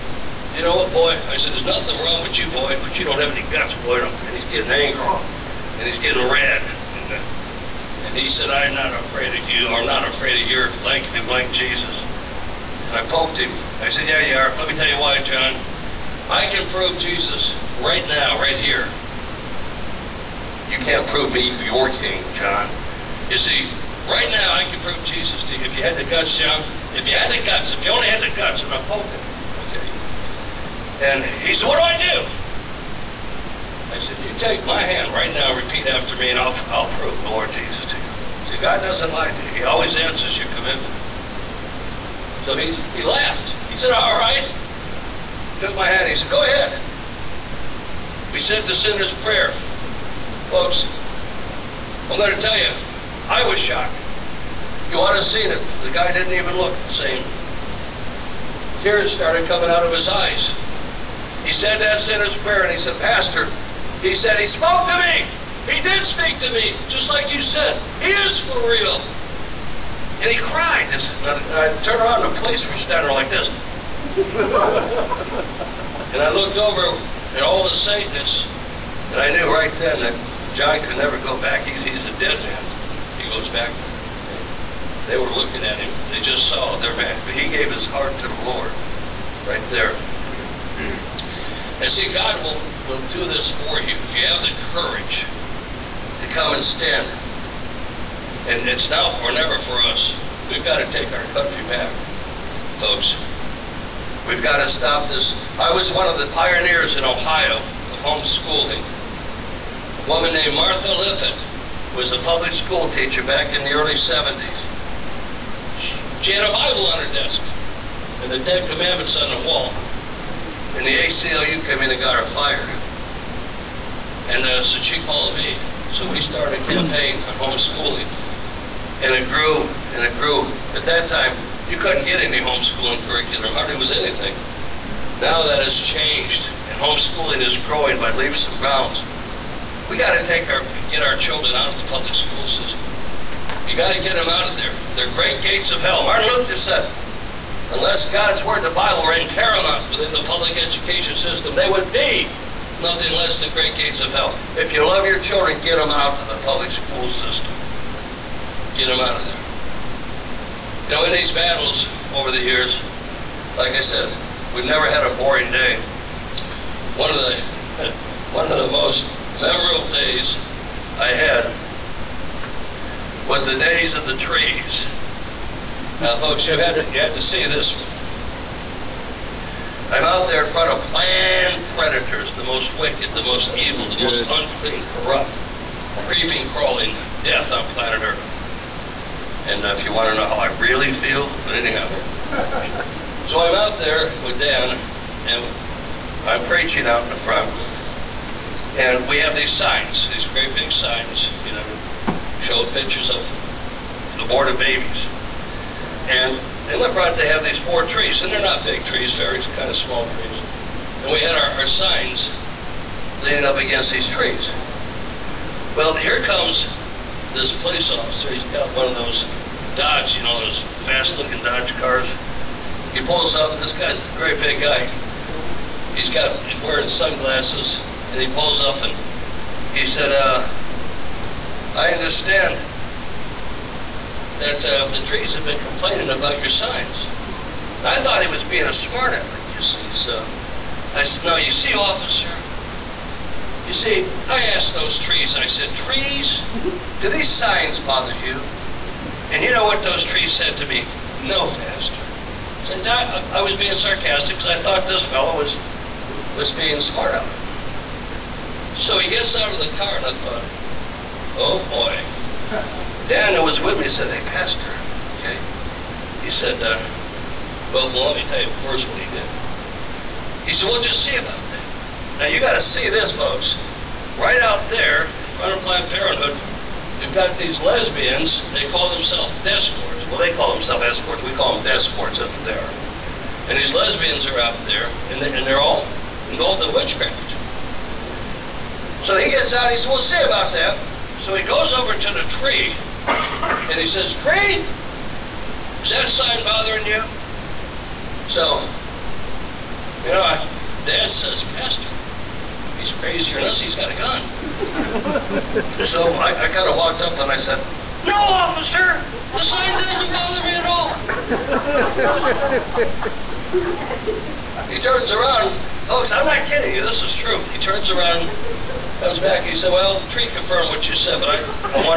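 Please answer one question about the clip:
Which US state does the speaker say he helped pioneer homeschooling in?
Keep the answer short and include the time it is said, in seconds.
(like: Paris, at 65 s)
Ohio, at 107 s.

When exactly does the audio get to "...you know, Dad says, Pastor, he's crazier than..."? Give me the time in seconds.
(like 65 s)
300 s.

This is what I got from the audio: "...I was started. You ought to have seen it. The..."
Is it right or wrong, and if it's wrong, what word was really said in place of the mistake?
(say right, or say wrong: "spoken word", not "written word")
wrong: "shocked", not "started".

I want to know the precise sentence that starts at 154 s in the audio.
If you love your children, get them out of the public school system.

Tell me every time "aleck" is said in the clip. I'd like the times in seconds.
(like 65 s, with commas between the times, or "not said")
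239 s, 257 s.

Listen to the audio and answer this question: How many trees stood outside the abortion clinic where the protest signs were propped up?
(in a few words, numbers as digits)
4.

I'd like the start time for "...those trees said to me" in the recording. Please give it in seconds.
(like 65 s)
249 s.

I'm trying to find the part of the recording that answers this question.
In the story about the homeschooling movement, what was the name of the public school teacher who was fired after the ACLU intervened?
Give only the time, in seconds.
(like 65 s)
110 s.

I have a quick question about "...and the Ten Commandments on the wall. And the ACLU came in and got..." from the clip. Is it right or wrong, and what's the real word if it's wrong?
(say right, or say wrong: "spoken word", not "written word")
right.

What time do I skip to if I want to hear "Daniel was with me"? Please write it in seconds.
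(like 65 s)
263 s.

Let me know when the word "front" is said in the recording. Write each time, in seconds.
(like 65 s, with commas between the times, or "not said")
180 s, 197 s, 275 s.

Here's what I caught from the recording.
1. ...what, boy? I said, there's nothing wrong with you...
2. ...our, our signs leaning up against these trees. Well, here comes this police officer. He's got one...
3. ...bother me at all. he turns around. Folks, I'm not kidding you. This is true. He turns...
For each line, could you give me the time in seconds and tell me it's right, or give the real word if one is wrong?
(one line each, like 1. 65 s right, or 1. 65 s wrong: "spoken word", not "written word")
1. 0 s right
2. 211 s right
3. 311 s right.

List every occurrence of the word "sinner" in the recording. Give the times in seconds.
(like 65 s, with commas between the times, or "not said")
48 s, 61 s.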